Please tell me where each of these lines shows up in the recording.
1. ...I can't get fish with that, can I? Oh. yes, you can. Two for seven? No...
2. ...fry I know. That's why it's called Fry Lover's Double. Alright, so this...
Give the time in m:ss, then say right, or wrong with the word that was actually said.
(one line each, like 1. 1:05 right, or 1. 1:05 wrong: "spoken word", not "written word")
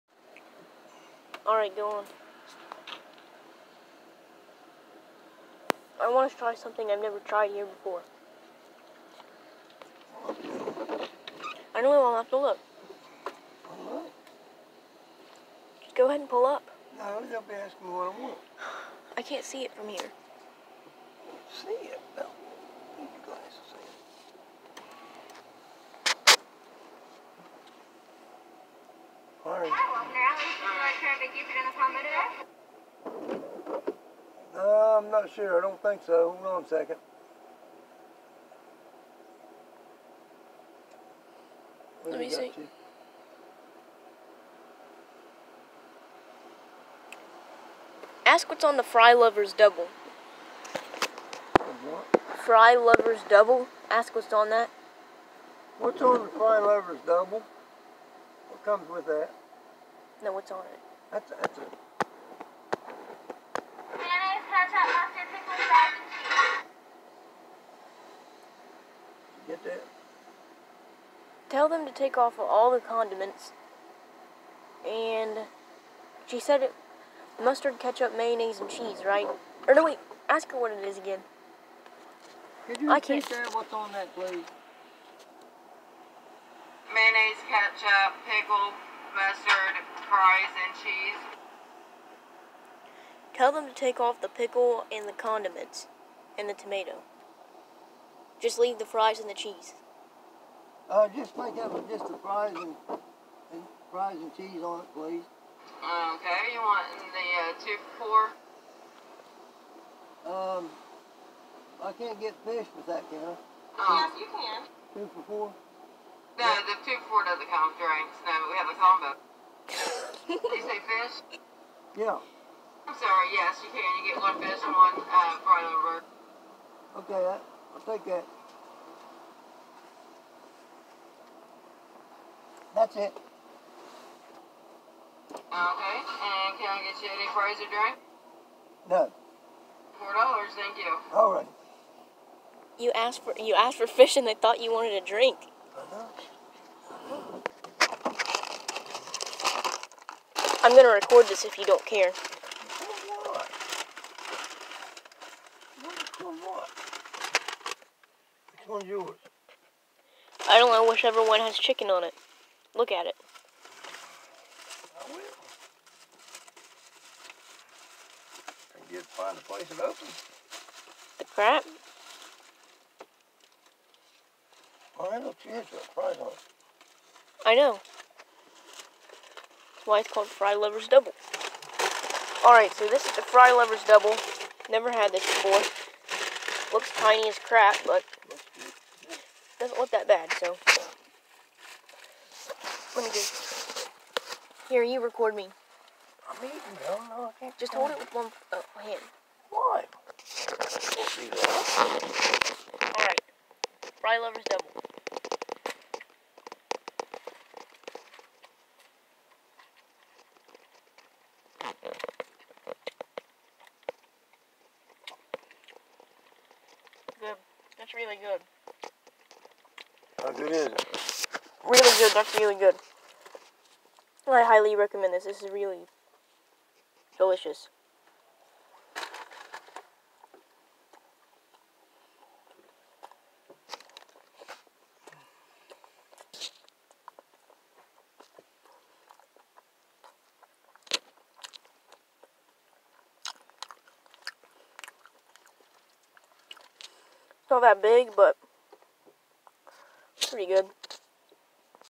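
1. 1:51 wrong: "four", not "seven"
2. 2:55 right.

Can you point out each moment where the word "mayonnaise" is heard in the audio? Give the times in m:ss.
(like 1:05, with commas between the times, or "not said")
1:03, 1:18, 1:26.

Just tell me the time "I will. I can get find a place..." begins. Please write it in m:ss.
2:45.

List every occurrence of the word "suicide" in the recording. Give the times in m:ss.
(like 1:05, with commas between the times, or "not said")
not said.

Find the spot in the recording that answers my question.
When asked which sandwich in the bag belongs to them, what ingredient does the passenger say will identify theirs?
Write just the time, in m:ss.
2:41.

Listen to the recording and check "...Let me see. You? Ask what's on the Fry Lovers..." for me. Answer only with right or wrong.
right.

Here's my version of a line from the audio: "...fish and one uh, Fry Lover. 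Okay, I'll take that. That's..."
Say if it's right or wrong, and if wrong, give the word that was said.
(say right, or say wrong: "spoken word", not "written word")
right.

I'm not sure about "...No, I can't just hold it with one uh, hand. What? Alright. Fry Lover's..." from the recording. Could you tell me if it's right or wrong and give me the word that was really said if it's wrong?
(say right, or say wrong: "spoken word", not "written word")
right.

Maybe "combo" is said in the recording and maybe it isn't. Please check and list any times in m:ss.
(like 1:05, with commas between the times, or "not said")
1:58.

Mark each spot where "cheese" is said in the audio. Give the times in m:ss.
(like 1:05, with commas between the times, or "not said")
1:06, 1:18, 1:30, 1:39, 1:44.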